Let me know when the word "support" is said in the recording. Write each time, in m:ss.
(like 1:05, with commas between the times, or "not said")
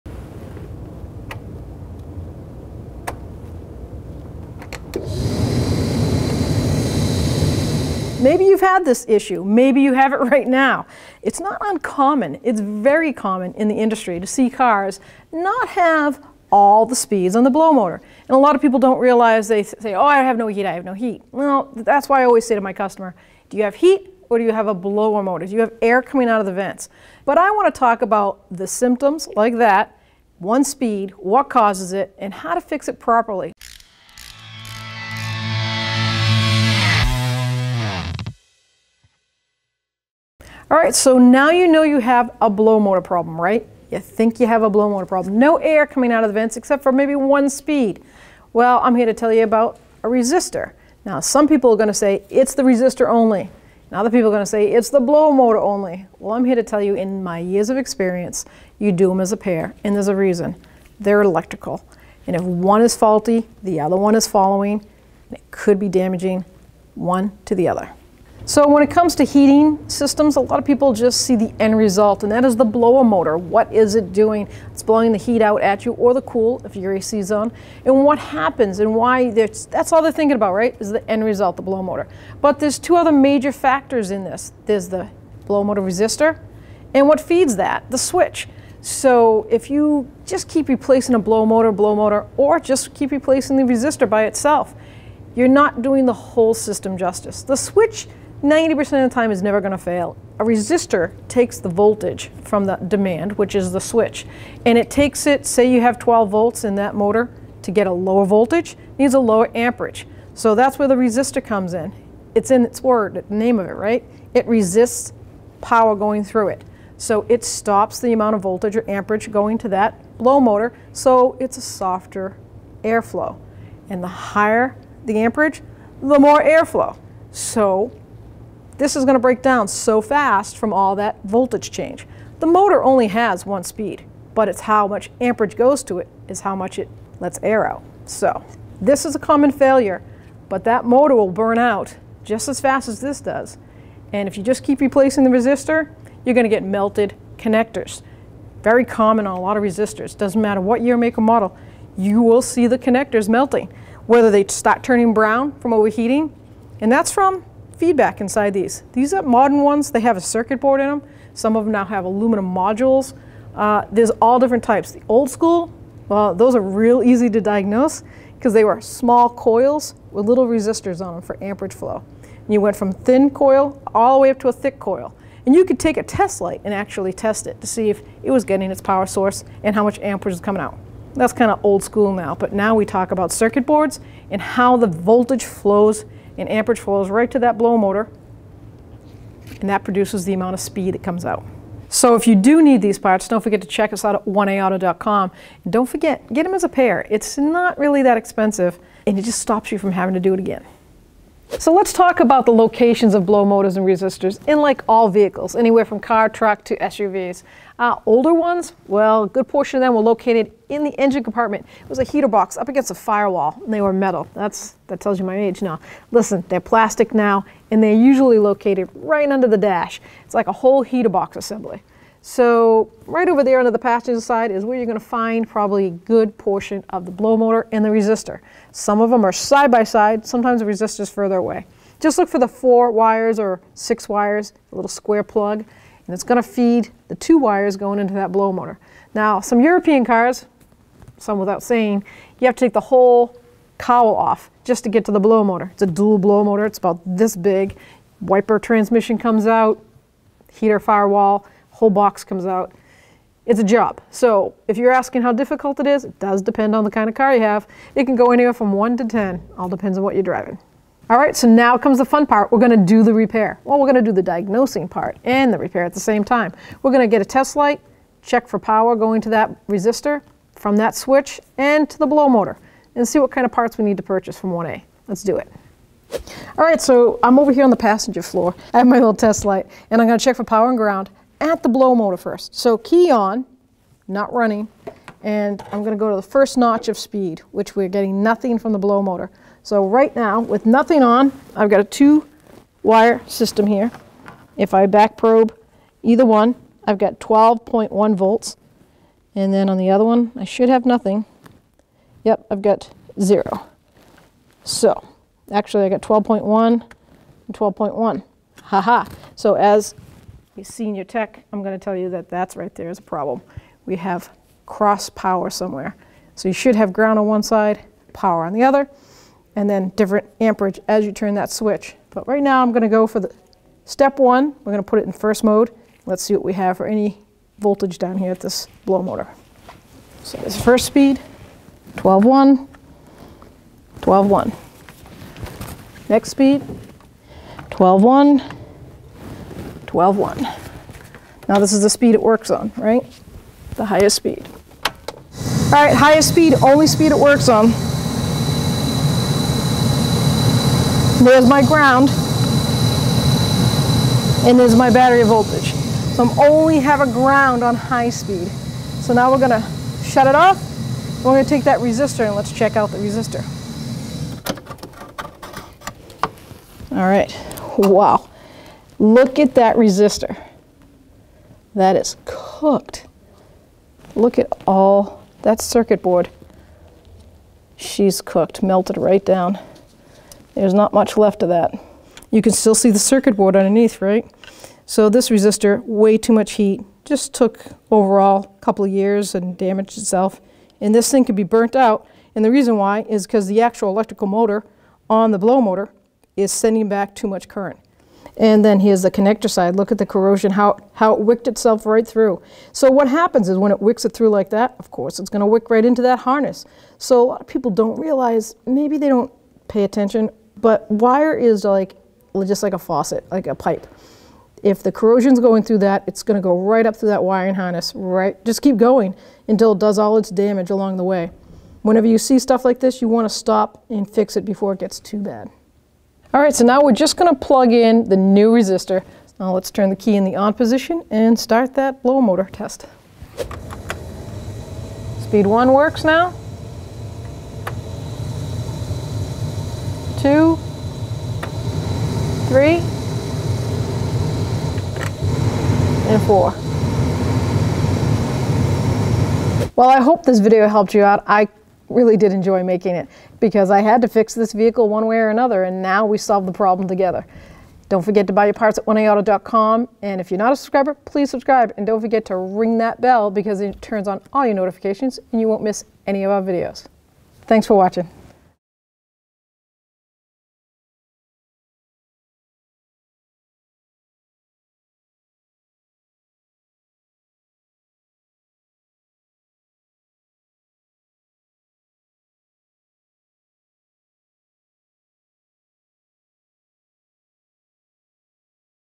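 not said.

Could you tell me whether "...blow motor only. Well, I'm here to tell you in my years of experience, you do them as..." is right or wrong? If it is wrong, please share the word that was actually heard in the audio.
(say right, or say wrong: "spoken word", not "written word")
right.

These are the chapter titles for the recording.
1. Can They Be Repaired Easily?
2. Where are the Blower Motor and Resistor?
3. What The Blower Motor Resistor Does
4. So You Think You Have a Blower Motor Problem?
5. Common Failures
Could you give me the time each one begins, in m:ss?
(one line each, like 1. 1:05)
1. 4:21
2. 3:21
3. 1:40
4. 0:40
5. 2:13.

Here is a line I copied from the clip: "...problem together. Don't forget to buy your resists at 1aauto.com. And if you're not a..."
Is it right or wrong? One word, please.
wrong.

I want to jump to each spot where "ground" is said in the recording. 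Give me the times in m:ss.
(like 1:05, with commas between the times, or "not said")
4:40, 5:16, 5:51, 5:57.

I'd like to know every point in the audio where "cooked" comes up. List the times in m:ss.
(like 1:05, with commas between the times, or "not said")
6:12, 6:18.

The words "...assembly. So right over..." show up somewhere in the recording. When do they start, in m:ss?
3:41.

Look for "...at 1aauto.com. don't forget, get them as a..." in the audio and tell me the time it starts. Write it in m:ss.
3:14.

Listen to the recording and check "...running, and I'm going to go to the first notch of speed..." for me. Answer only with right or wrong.
right.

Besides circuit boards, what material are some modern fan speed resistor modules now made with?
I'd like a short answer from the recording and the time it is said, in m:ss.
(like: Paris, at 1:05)
aluminum, at 2:42.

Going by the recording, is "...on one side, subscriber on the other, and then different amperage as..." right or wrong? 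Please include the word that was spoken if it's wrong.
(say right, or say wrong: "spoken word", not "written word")
wrong: "power", not "subscriber".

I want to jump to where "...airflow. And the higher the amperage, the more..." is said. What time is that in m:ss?
2:02.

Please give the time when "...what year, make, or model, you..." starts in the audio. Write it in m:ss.
2:30.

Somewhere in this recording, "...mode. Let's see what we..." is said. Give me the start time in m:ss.
5:25.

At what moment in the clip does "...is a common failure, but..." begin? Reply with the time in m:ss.
2:19.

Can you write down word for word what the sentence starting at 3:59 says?
Now some European cars, some without saying, you have to take the whole cowl off just to get to the blow motor.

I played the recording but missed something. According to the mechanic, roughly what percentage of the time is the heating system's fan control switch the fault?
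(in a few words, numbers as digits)
90%.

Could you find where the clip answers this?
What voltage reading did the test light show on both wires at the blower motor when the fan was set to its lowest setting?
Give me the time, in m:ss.
4:57.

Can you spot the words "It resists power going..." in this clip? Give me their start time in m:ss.
1:54.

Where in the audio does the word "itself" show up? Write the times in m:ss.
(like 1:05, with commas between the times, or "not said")
1:34, 6:29, 6:41.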